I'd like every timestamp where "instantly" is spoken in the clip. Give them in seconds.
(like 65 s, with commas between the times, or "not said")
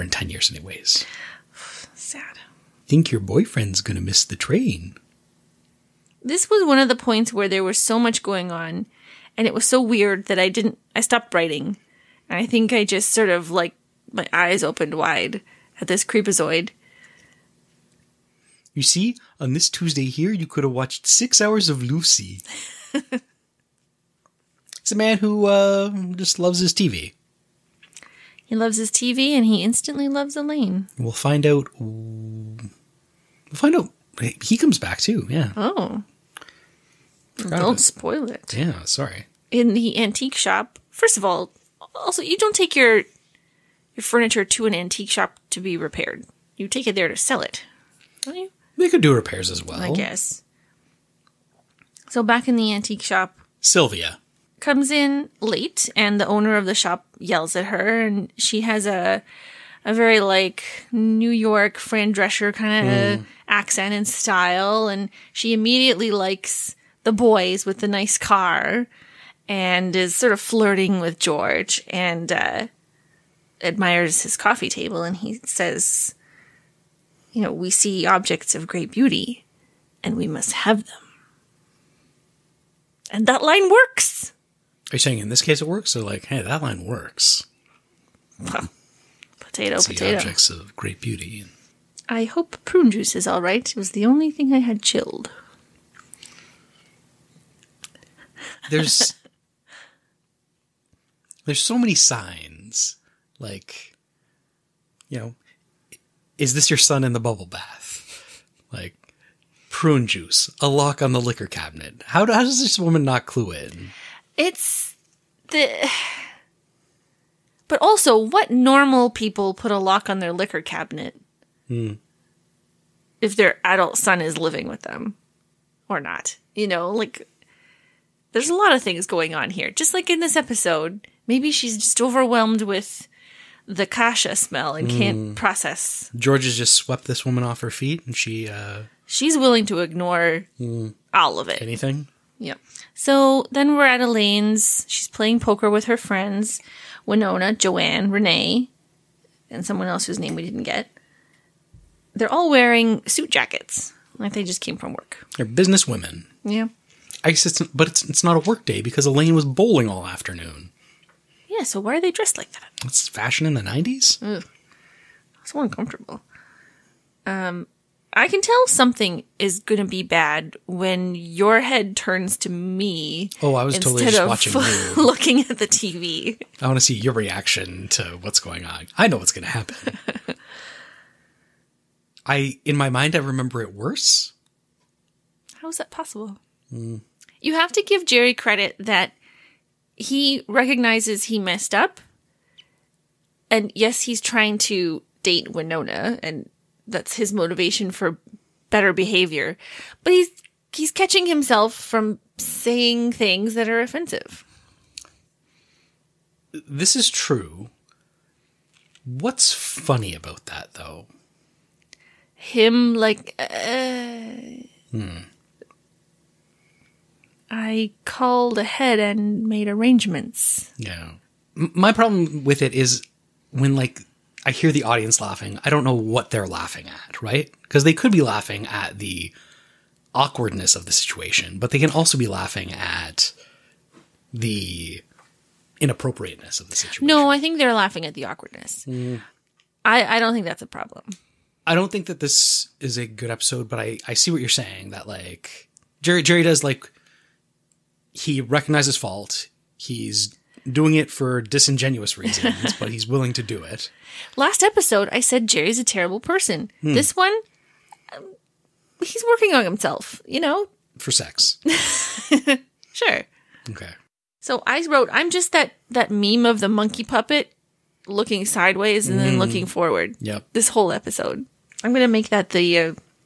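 29 s.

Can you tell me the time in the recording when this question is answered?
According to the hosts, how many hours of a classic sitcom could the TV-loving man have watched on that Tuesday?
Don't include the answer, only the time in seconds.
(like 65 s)
21 s.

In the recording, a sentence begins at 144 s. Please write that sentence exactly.
She's playing poker with her friends Winona, Joanne, Renee, and someone else whose name we didn't get.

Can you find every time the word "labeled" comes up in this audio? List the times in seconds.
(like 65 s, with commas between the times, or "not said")
not said.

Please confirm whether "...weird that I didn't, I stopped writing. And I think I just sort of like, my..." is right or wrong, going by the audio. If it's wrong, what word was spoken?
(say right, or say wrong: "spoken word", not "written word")
right.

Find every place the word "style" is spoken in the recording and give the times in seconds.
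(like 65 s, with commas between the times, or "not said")
64 s.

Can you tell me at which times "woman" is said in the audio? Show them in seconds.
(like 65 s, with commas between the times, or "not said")
112 s, 137 s.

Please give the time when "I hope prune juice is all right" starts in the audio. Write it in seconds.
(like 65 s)
92 s.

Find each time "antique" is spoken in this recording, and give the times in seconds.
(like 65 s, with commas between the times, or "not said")
40 s, 44 s, 52 s.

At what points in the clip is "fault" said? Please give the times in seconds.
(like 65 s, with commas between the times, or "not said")
248 s.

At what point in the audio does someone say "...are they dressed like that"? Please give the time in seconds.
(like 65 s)
161 s.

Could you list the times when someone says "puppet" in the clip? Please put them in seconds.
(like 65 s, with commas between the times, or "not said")
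267 s.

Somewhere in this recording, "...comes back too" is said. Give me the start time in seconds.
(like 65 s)
34 s.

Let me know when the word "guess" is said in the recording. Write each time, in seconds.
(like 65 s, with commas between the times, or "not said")
49 s, 157 s.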